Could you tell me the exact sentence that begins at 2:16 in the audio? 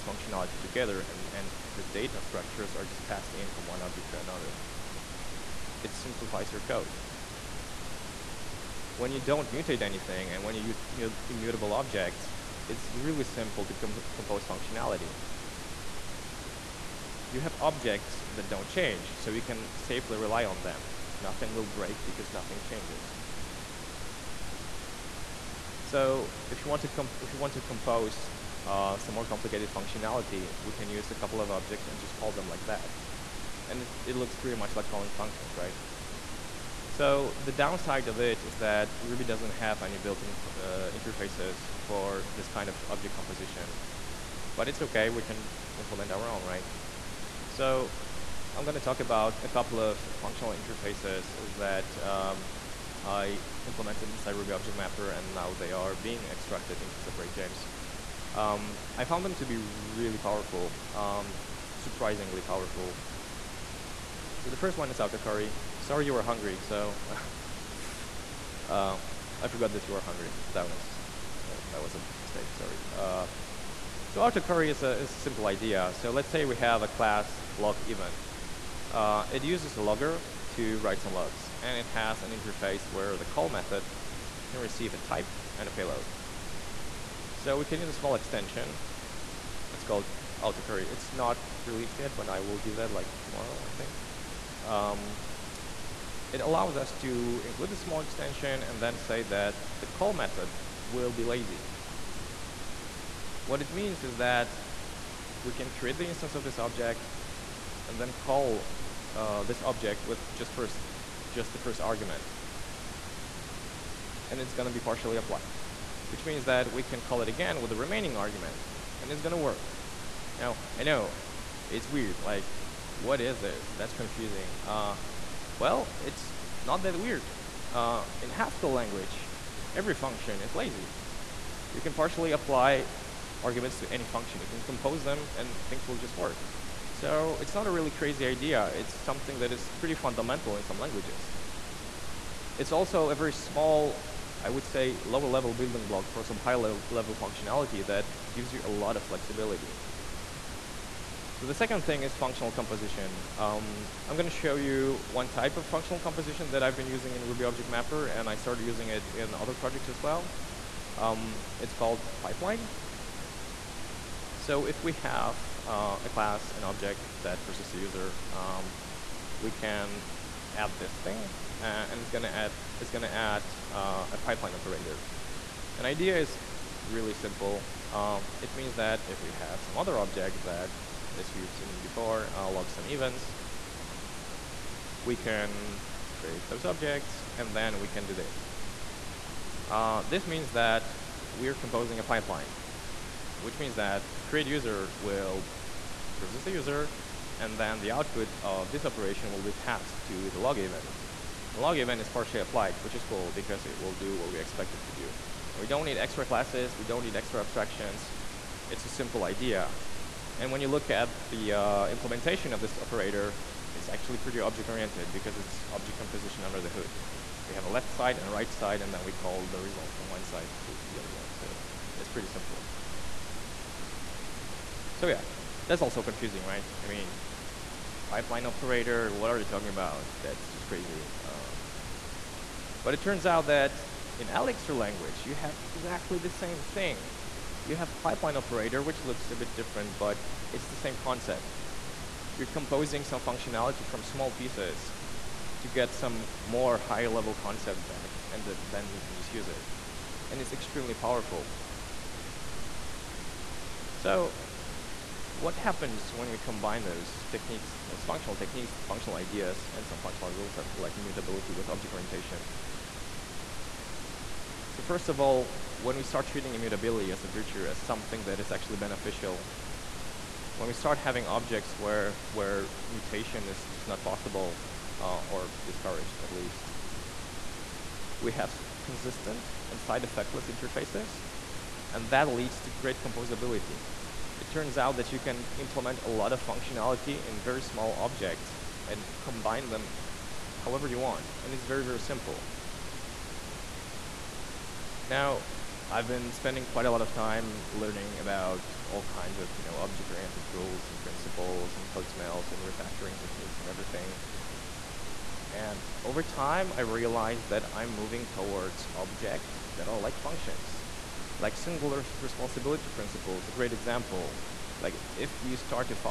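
So it's not a really crazy idea.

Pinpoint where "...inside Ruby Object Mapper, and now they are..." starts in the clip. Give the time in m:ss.
0:54.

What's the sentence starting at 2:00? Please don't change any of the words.
Now, I know, it's weird, like, what is this?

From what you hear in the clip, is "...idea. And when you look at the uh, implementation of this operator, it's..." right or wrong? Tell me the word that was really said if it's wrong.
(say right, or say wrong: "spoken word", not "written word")
right.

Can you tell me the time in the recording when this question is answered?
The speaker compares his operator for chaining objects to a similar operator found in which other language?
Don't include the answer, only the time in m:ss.
3:54.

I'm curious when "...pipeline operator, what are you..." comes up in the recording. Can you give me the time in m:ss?
3:48.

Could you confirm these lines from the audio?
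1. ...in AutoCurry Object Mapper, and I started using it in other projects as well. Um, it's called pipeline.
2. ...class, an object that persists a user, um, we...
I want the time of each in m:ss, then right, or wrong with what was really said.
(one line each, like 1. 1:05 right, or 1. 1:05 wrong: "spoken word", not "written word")
1. 2:37 wrong: "Ruby", not "AutoCurry"
2. 2:46 right.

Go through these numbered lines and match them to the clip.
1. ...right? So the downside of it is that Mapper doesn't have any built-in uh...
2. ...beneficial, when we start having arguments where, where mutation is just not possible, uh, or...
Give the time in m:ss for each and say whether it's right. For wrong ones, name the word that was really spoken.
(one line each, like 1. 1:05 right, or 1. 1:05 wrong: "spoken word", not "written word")
1. 0:35 wrong: "Ruby", not "Mapper"
2. 4:28 wrong: "objects", not "arguments".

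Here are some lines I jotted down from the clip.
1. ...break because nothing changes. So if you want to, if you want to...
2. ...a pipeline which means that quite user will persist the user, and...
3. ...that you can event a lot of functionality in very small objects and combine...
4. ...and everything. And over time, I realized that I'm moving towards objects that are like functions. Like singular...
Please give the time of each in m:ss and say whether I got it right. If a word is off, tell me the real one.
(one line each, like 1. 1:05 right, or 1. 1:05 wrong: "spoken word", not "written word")
1. 0:21 right
2. 3:11 wrong: "create", not "quite"
3. 4:44 wrong: "implement", not "event"
4. 5:03 right.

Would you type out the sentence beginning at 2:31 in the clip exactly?
So the second thing is functional composition.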